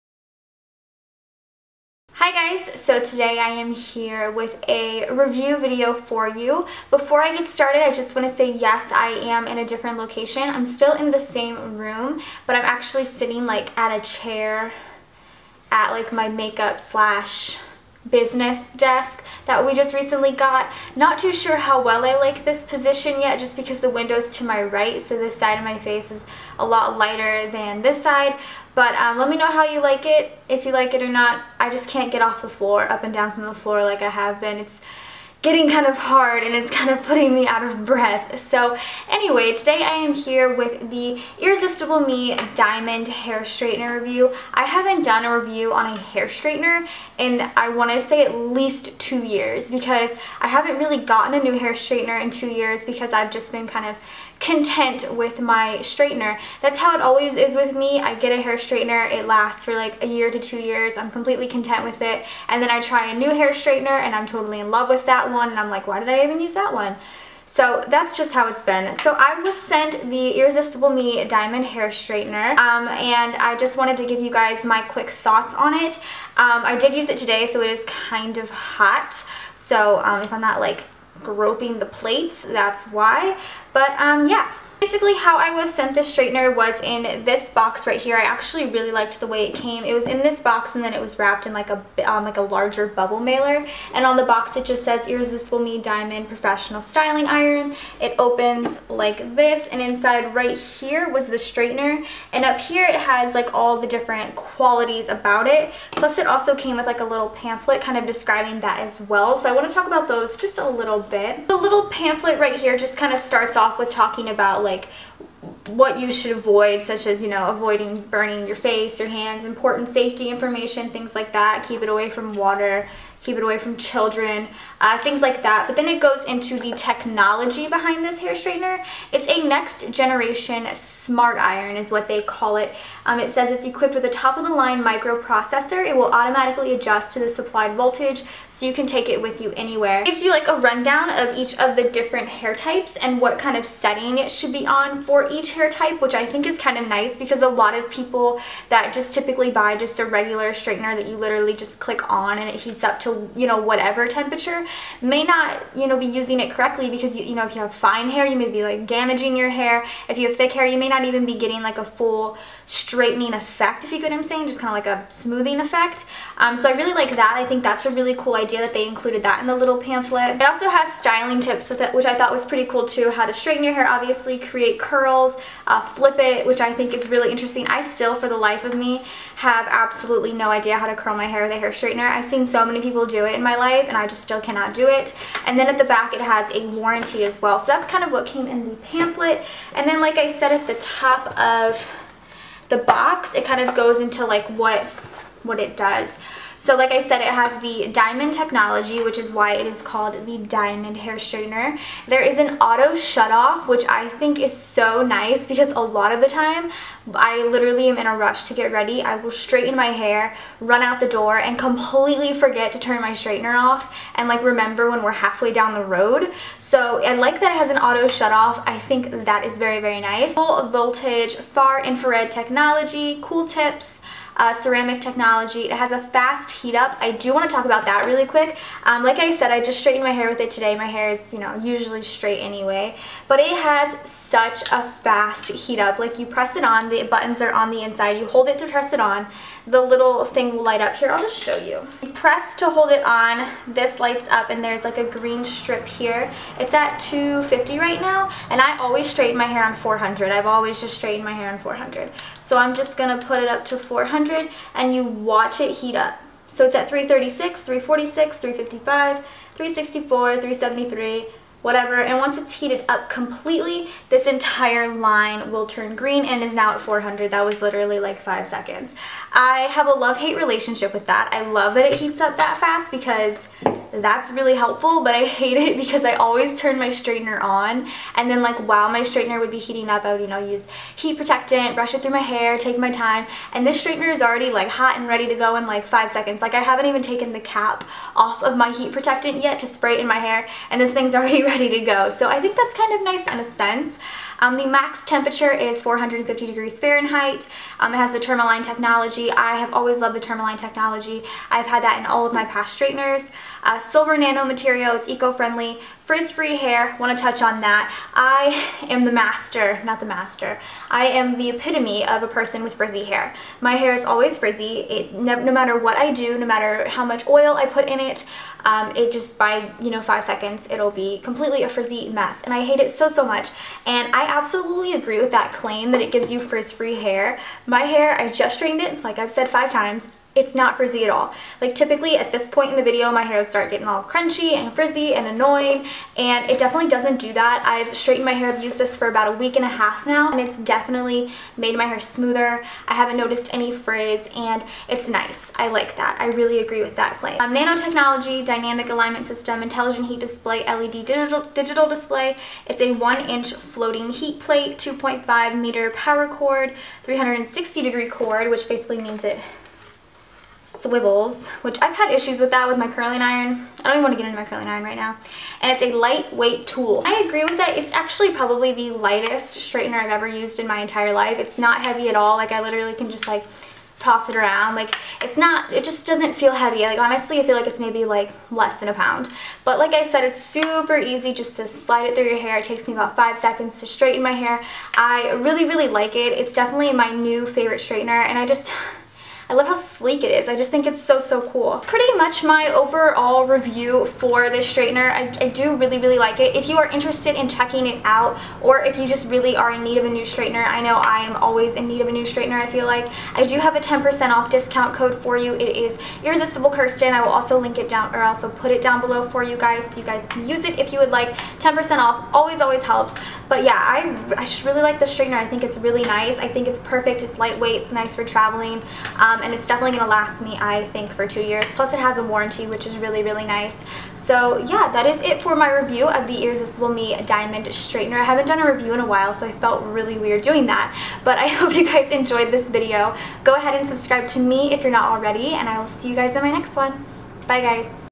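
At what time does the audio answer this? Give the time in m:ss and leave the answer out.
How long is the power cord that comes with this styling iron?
5:54.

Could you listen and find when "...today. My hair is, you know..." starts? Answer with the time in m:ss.
3:50.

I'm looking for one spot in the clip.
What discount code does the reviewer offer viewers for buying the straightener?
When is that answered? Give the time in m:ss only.
6:46.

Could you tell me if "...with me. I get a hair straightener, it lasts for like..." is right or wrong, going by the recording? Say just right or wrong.
right.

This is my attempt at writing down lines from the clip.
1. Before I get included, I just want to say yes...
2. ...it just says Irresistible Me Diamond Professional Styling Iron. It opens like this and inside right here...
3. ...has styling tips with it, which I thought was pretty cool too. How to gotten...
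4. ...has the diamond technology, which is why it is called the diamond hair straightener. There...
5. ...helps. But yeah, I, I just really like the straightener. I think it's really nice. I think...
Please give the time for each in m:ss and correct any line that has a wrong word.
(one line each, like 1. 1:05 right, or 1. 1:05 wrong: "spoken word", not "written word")
1. 0:06 wrong: "started", not "included"
2. 1:34 right
3. 2:50 wrong: "straighten", not "gotten"
4. 3:17 right
5. 6:52 right.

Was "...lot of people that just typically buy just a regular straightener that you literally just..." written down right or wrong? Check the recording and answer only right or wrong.
right.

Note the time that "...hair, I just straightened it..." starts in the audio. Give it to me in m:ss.
5:27.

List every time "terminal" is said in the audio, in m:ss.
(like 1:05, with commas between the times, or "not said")
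not said.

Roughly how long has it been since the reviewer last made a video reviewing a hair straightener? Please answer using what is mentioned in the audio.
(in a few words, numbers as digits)
2 years.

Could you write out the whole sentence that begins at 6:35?
I, I do really, really like it.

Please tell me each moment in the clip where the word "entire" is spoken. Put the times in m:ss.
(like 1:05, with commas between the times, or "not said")
4:24, 6:10.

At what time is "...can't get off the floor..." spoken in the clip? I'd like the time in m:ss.
0:31.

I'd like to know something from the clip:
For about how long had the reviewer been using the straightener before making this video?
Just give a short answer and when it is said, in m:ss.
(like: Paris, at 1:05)
a week and a half, at 5:39.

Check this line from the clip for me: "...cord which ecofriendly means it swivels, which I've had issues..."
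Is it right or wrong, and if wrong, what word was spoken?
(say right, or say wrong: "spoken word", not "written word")
wrong: "basically", not "ecofriendly".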